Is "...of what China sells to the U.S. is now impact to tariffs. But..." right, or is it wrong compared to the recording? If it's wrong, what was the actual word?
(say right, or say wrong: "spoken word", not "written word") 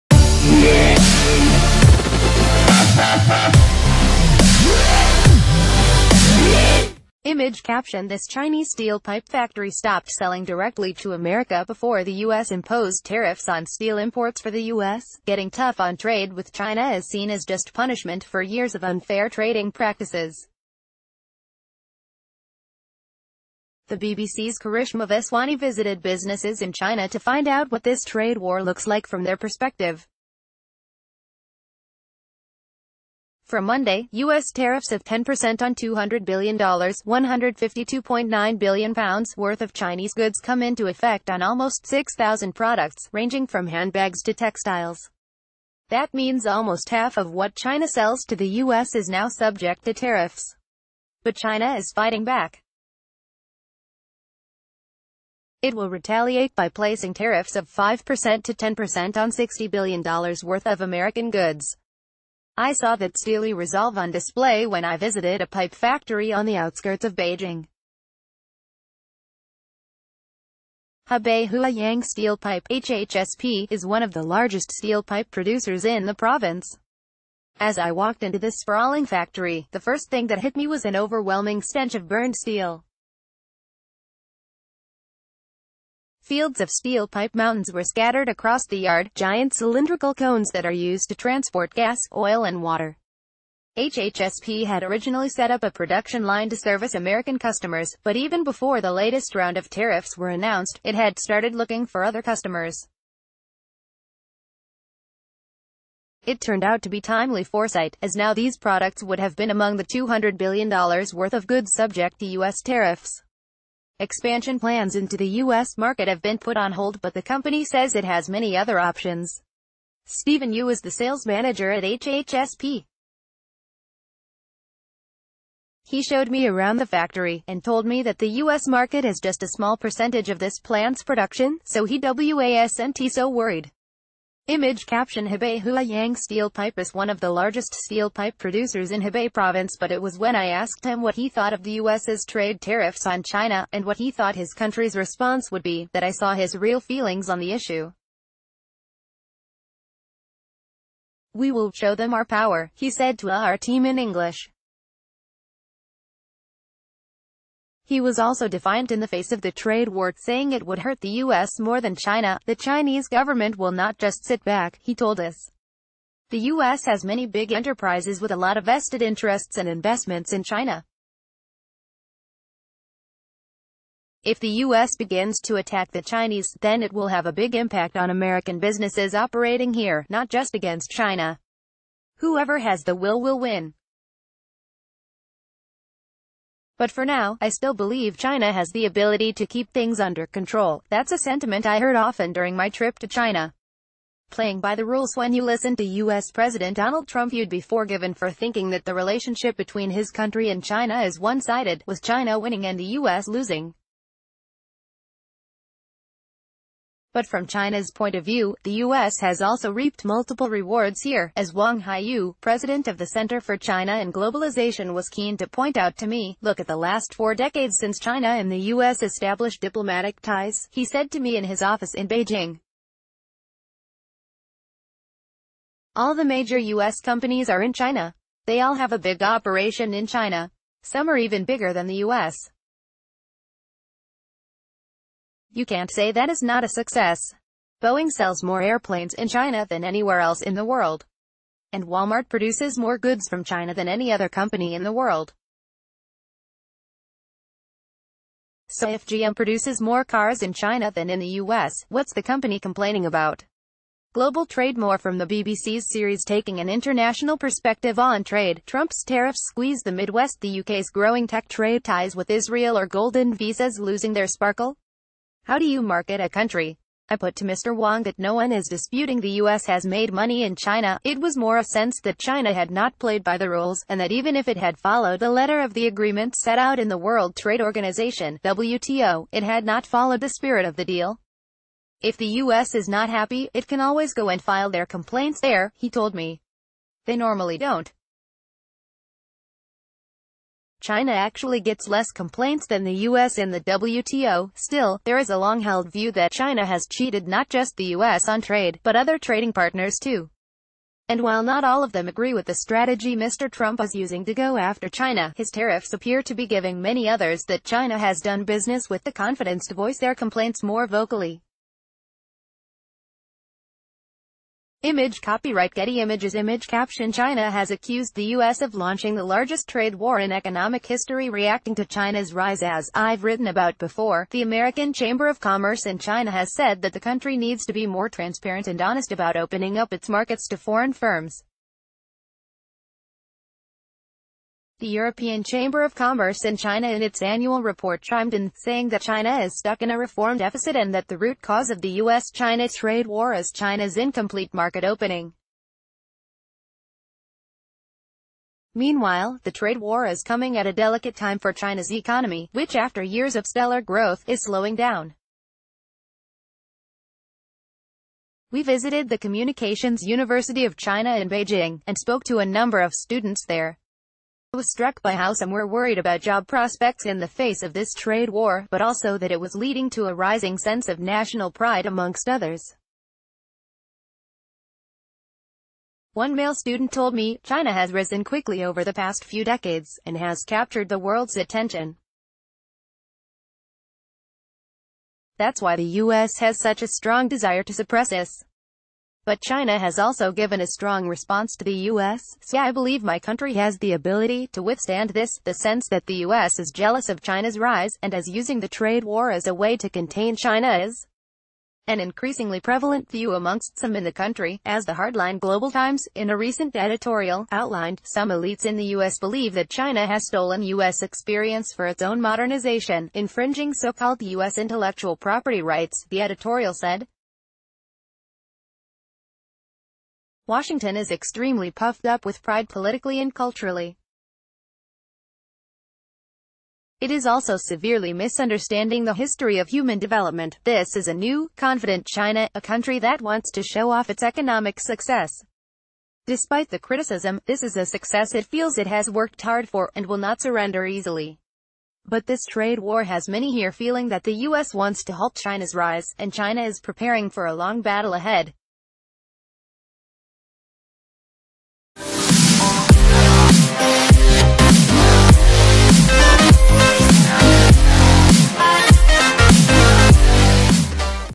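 wrong: "subject", not "impact".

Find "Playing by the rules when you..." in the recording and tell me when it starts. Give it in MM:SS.
03:14.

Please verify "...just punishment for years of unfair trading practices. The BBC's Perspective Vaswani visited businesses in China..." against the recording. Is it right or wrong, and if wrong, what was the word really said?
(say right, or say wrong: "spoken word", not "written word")
wrong: "Karishma", not "Perspective".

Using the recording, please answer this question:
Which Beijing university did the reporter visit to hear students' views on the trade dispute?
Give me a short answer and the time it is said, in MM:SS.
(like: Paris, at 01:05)
Communications University of China, at 05:59.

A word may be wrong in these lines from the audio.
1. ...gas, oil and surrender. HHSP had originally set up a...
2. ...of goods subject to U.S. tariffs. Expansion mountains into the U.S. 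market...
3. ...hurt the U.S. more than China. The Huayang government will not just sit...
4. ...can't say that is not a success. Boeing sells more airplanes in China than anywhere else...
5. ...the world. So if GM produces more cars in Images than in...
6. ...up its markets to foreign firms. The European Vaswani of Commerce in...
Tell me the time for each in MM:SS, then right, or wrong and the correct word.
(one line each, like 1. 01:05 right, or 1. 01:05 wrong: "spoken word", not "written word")
1. 01:31 wrong: "water", not "surrender"
2. 01:51 wrong: "plans", not "mountains"
3. 02:40 wrong: "Chinese", not "Huayang"
4. 03:55 right
5. 04:04 wrong: "China", not "Images"
6. 05:29 wrong: "Chamber", not "Vaswani".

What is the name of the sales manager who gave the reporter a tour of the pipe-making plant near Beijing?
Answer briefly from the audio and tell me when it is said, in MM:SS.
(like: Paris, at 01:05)
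Stephen Yu, at 02:00.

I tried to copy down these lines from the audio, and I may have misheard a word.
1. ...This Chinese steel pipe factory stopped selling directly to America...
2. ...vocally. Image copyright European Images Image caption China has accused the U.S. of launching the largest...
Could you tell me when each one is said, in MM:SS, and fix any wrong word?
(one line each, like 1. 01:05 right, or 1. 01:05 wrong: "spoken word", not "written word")
1. 00:08 right
2. 05:10 wrong: "Getty", not "European".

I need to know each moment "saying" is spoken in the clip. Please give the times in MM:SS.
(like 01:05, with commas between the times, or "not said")
02:40, 05:38.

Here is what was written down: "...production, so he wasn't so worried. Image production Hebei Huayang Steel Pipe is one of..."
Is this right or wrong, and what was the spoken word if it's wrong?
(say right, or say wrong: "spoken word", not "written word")
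wrong: "caption", not "production".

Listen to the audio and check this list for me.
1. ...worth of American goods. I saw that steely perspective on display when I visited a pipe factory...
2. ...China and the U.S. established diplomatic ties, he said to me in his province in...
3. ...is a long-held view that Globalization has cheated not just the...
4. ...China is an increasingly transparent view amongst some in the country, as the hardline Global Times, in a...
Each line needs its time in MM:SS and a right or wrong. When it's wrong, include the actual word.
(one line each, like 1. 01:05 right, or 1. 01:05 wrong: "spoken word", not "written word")
1. 01:00 wrong: "resolve", not "perspective"
2. 03:37 wrong: "office", not "province"
3. 04:55 wrong: "China", not "Globalization"
4. 06:40 wrong: "prevalent", not "transparent".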